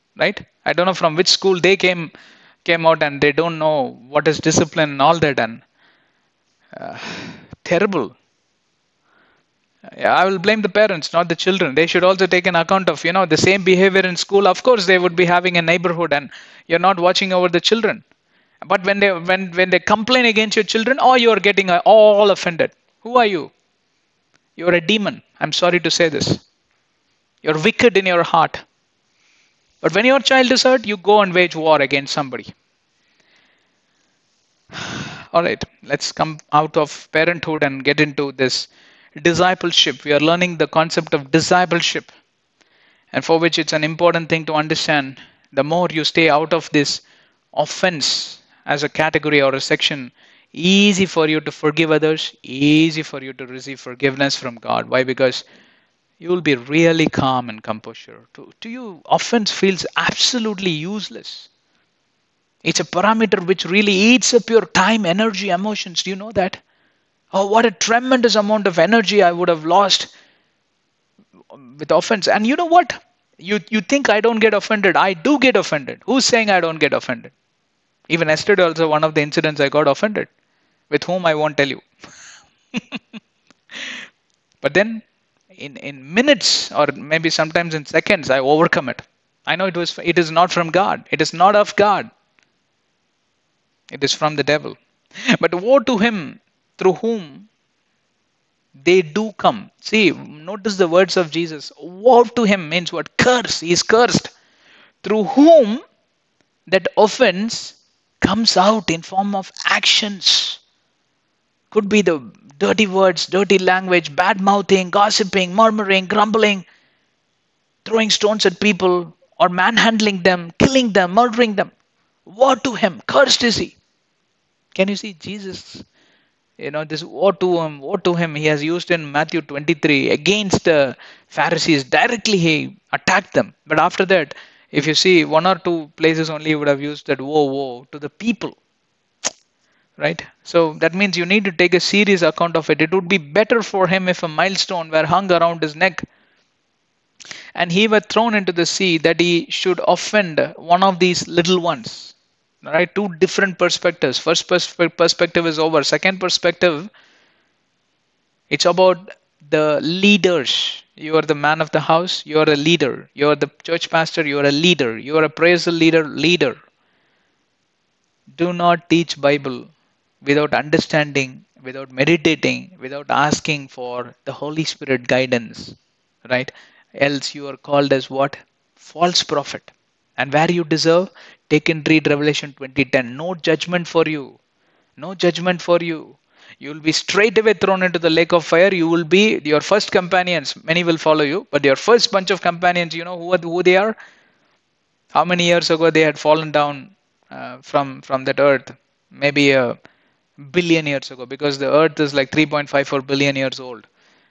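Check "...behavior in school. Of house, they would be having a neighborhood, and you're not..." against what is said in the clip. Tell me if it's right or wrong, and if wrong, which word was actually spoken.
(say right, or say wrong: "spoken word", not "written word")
wrong: "course", not "house".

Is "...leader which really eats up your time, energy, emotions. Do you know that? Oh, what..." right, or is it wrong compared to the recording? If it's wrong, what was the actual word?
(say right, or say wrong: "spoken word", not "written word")
wrong: "parameter", not "leader".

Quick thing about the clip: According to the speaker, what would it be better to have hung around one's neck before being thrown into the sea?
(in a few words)
milestone.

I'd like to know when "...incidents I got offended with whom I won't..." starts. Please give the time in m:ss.
1:19.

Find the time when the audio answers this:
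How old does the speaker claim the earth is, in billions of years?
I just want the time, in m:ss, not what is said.
3:22.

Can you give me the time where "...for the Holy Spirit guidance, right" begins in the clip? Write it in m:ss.
2:53.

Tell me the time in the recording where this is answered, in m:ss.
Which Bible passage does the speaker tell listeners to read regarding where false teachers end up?
3:02.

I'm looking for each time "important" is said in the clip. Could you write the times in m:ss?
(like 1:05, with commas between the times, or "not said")
0:43.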